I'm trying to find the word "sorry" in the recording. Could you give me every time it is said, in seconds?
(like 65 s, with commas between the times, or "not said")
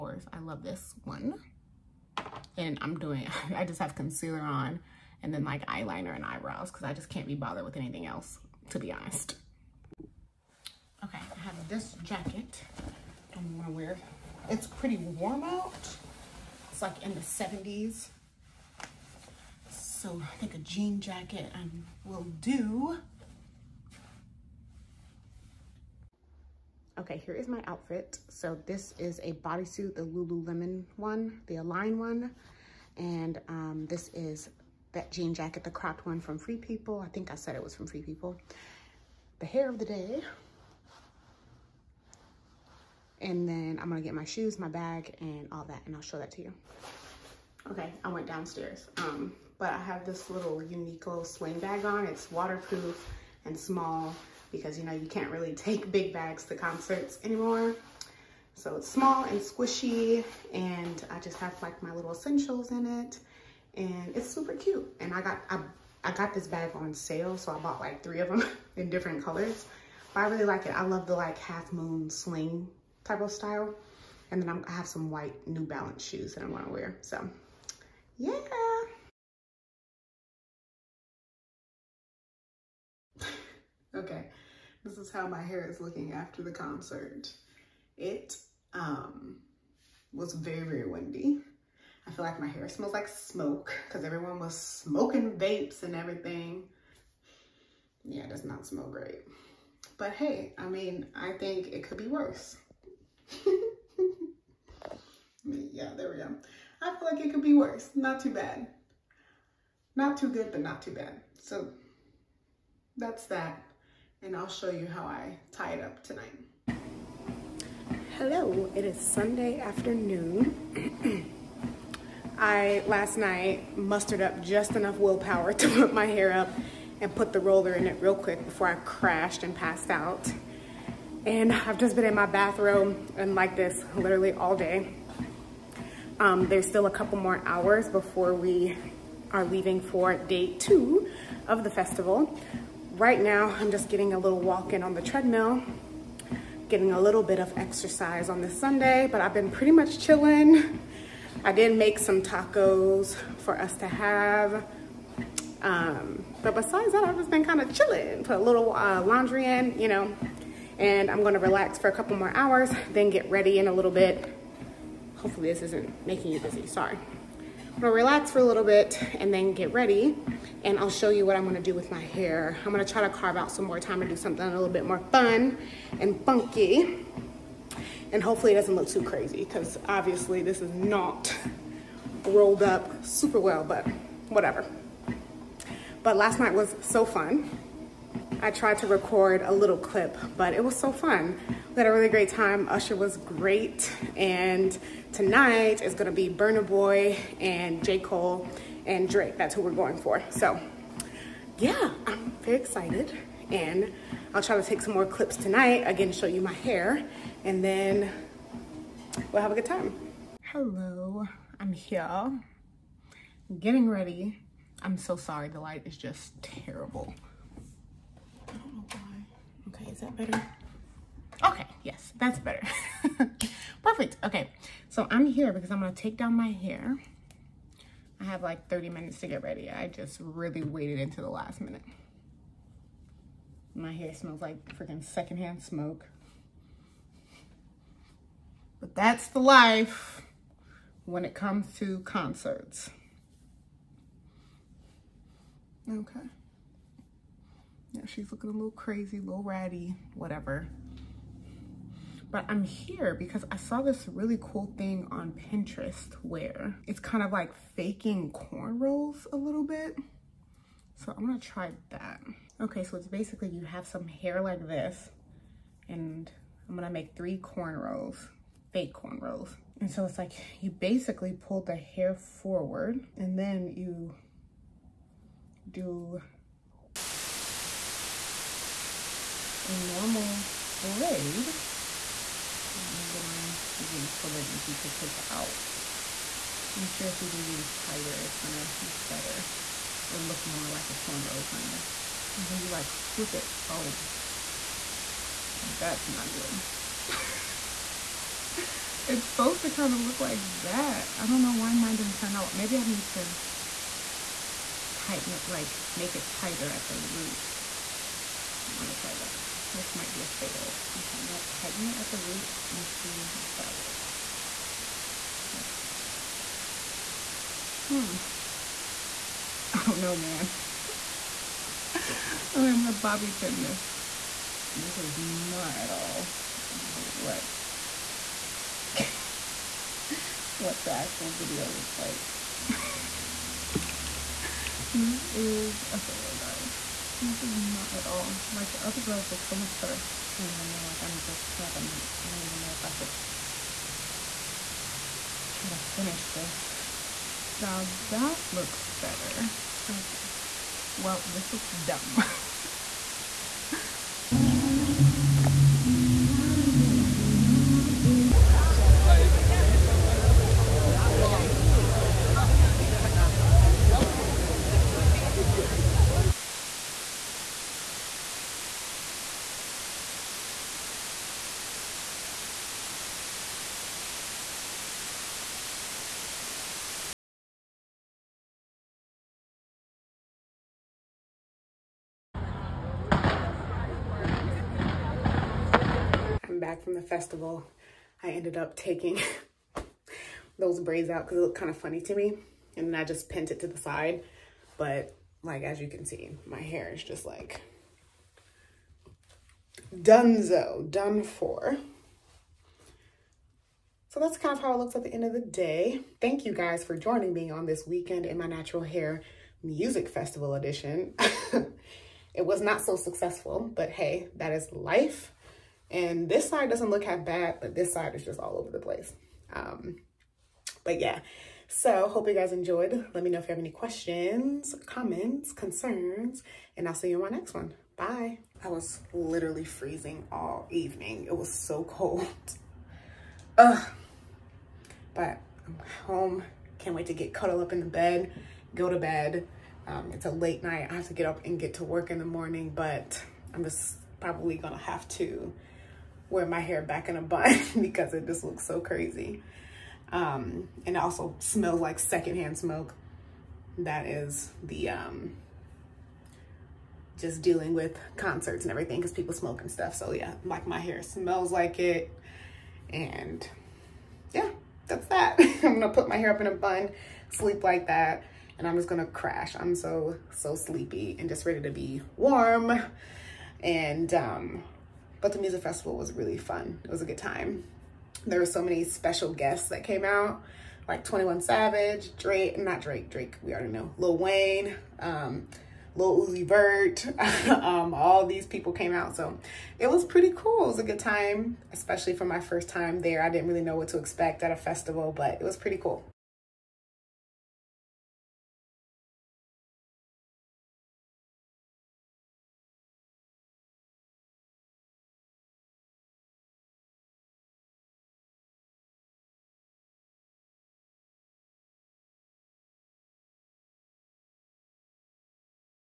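166 s, 215 s.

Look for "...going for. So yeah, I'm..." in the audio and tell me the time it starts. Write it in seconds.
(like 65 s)
199 s.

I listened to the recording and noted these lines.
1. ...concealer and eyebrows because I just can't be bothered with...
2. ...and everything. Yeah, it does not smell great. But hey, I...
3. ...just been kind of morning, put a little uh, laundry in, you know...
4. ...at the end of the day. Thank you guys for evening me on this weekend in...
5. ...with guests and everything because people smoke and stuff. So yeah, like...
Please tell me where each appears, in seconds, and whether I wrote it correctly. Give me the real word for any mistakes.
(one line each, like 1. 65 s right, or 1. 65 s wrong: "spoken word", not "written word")
1. 5 s wrong: "eyeliner", not "concealer"
2. 95 s right
3. 157 s wrong: "chilling", not "morning"
4. 404 s wrong: "joining", not "evening"
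5. 457 s wrong: "concerts", not "guests".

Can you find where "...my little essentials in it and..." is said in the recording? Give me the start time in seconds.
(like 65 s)
61 s.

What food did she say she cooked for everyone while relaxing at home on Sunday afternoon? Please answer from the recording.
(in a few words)
Tacos.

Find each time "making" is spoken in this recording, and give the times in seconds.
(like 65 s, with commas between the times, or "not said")
166 s.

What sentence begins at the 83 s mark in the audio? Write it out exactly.
Okay, this is how my hair is looking after the concert.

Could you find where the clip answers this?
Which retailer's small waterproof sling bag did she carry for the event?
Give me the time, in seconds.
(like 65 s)
50 s.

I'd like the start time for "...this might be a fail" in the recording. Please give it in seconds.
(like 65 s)
309 s.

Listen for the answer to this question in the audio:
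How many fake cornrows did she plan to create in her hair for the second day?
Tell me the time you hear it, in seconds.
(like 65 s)
267 s.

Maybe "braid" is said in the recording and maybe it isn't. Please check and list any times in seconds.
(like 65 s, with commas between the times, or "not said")
280 s, 390 s.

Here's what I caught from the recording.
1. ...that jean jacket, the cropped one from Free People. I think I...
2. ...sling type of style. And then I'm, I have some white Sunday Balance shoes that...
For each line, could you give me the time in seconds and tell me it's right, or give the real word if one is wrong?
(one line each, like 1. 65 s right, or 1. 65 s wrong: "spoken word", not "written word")
1. 34 s right
2. 72 s wrong: "New", not "Sunday".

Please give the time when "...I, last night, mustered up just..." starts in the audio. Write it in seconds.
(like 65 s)
122 s.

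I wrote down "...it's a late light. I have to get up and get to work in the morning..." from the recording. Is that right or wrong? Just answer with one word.
wrong.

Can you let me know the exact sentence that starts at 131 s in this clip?
And I've just been in my bathroom and like this literally all day.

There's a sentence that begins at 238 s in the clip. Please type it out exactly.
But that's the life when it comes to concerts.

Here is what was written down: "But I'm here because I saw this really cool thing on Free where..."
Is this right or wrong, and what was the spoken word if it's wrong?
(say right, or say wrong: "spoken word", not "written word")
wrong: "Pinterest", not "Free".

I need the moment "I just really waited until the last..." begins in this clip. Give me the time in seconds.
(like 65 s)
229 s.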